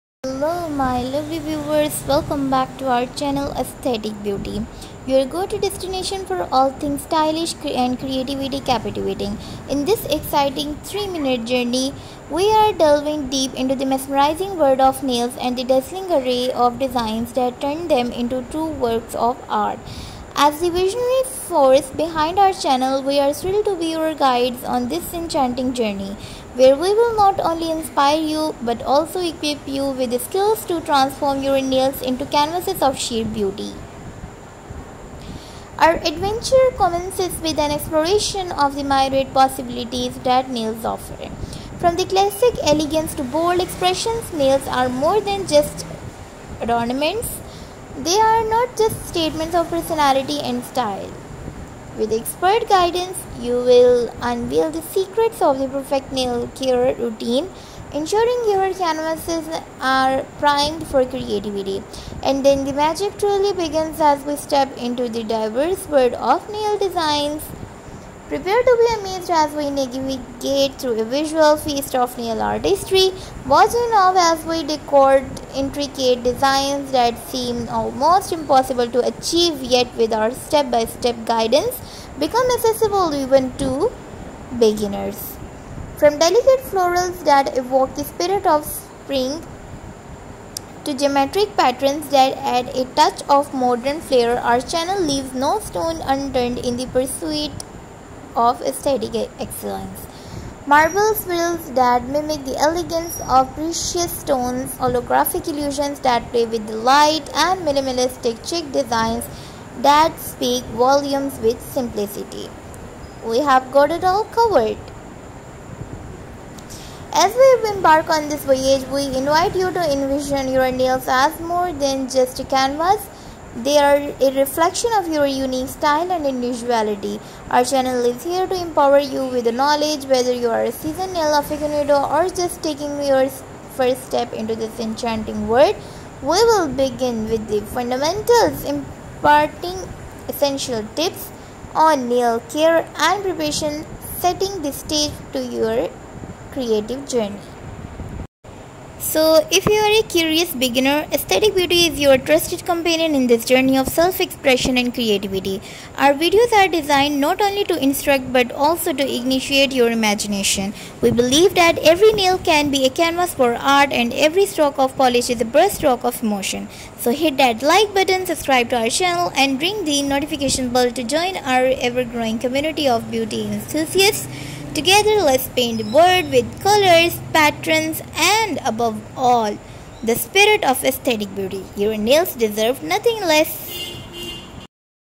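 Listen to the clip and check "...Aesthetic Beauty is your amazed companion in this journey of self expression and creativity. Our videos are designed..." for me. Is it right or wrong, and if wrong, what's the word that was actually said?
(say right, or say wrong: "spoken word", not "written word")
wrong: "trusted", not "amazed".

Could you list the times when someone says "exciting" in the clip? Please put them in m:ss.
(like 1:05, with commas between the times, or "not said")
0:10.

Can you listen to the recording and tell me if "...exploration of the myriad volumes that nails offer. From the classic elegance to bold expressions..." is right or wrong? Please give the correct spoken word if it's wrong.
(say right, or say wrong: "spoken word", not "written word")
wrong: "possibilities", not "volumes".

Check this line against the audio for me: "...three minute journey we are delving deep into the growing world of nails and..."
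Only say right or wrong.
wrong.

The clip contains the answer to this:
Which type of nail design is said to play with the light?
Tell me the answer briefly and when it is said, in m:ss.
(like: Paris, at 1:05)
holographic illusions, at 1:44.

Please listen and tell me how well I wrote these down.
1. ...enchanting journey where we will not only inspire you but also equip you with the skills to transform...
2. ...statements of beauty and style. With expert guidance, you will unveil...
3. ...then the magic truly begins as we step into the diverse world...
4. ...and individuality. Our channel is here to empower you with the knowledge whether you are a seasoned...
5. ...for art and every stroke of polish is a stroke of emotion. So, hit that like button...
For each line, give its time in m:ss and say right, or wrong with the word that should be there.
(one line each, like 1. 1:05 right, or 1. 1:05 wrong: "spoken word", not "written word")
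1. 0:25 right
2. 0:49 wrong: "personality", not "beauty"
3. 1:02 right
4. 2:06 right
5. 2:43 wrong: "brushstroke", not "stroke".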